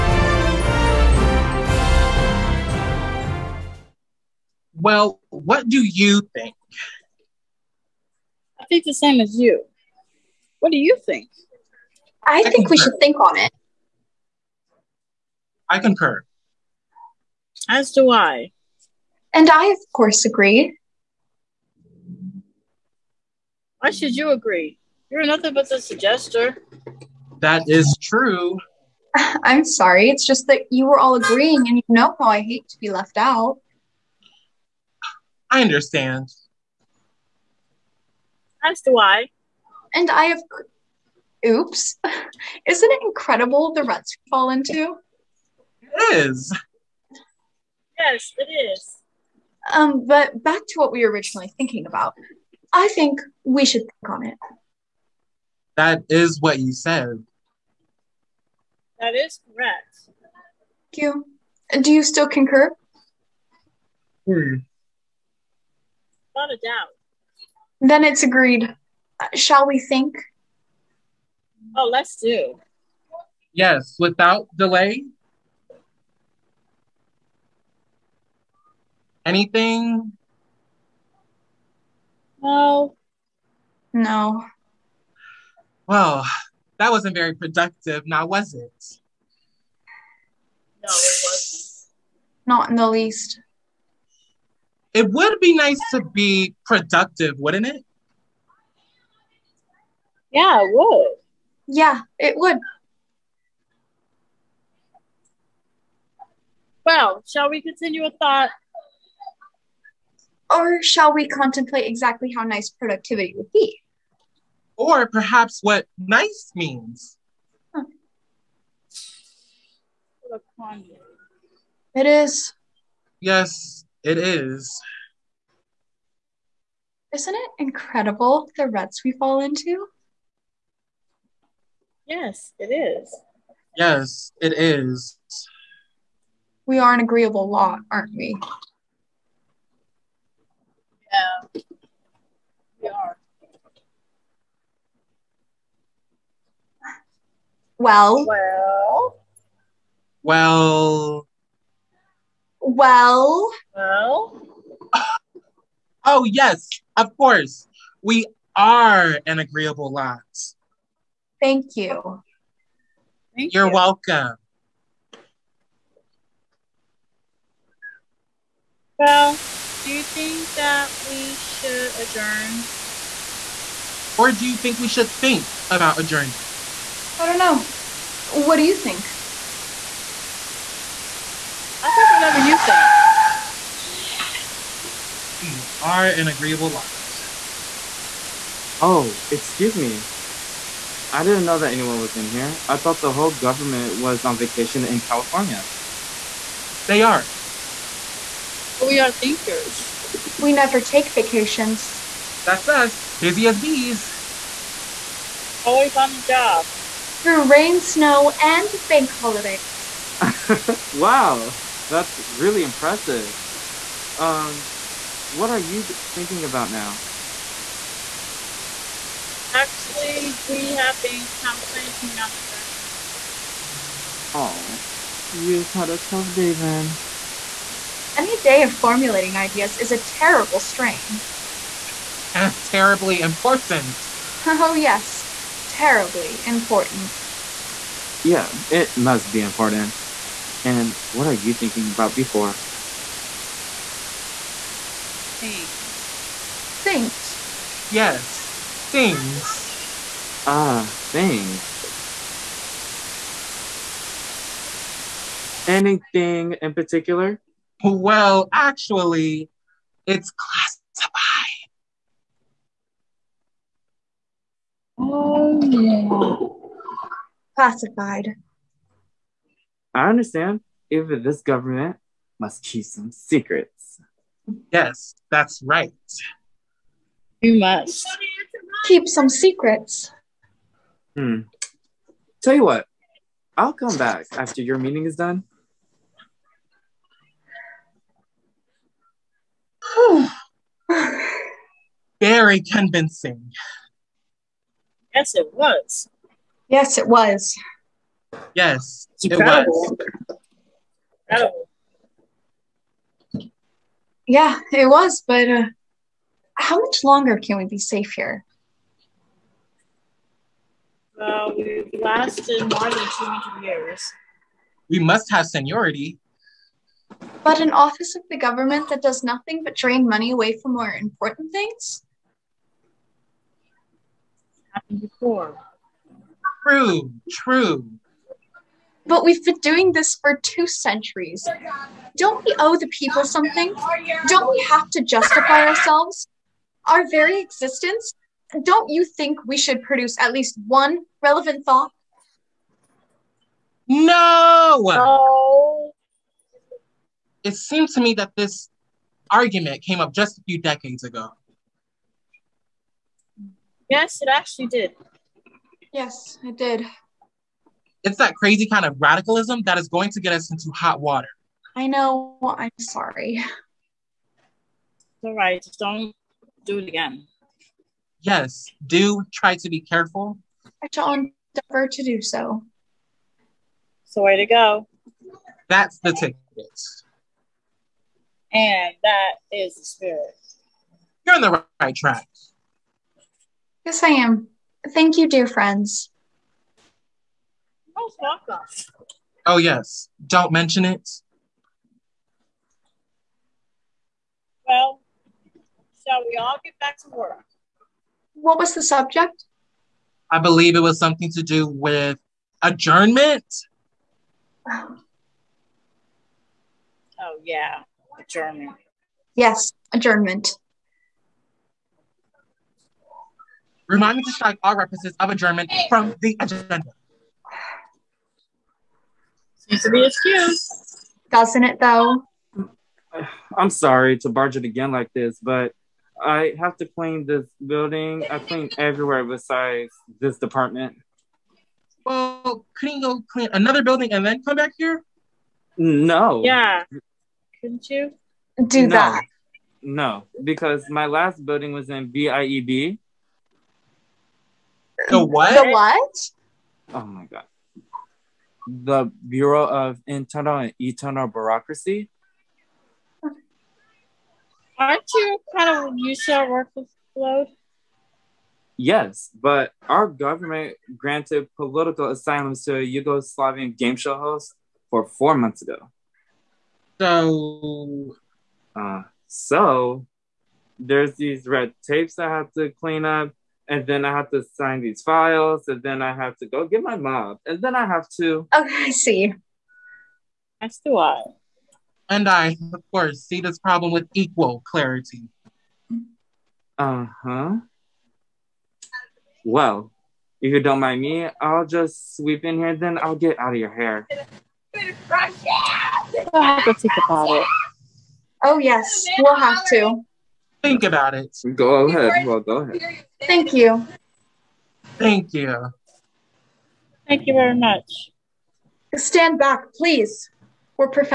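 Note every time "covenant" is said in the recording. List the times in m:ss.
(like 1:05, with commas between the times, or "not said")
not said.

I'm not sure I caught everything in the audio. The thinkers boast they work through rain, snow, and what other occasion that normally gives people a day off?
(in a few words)
bank holidays.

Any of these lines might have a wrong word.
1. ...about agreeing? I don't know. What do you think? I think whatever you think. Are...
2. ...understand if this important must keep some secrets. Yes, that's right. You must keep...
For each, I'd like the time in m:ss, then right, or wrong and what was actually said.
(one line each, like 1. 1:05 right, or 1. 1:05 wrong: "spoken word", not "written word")
1. 2:55 wrong: "adjourning", not "agreeing"
2. 4:30 wrong: "government", not "important".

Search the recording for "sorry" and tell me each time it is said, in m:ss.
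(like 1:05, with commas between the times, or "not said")
0:29, 6:02, 7:03.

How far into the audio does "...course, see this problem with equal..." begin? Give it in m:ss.
8:02.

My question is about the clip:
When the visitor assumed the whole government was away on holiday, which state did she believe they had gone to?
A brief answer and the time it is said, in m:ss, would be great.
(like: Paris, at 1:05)
California, at 3:15.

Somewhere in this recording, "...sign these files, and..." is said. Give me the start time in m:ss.
7:54.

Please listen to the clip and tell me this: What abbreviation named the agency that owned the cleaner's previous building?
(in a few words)
BIEB.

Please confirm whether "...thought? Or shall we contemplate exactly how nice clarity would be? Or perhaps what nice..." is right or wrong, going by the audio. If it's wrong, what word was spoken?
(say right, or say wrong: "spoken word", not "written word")
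wrong: "productivity", not "clarity".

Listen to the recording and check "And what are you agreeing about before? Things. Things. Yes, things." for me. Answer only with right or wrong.
wrong.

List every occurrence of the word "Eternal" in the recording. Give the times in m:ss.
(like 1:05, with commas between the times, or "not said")
7:30.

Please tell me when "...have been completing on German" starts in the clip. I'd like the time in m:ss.
3:40.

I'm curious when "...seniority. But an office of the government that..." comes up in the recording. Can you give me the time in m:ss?
5:15.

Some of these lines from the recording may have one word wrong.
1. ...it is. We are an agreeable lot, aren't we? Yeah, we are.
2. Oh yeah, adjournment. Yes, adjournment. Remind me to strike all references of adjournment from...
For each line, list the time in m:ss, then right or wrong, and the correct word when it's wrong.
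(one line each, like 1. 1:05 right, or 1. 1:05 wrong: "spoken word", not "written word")
1. 2:14 right
2. 6:44 right.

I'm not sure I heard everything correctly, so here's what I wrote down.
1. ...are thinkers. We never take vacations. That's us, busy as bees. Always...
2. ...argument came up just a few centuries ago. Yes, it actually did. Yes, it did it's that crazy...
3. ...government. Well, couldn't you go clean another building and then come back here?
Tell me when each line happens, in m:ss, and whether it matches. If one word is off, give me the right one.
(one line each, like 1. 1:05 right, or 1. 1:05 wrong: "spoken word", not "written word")
1. 3:18 right
2. 5:49 wrong: "decades", not "centuries"
3. 7:10 wrong: "department", not "government".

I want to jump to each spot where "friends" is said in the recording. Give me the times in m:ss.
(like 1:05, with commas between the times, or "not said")
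6:25.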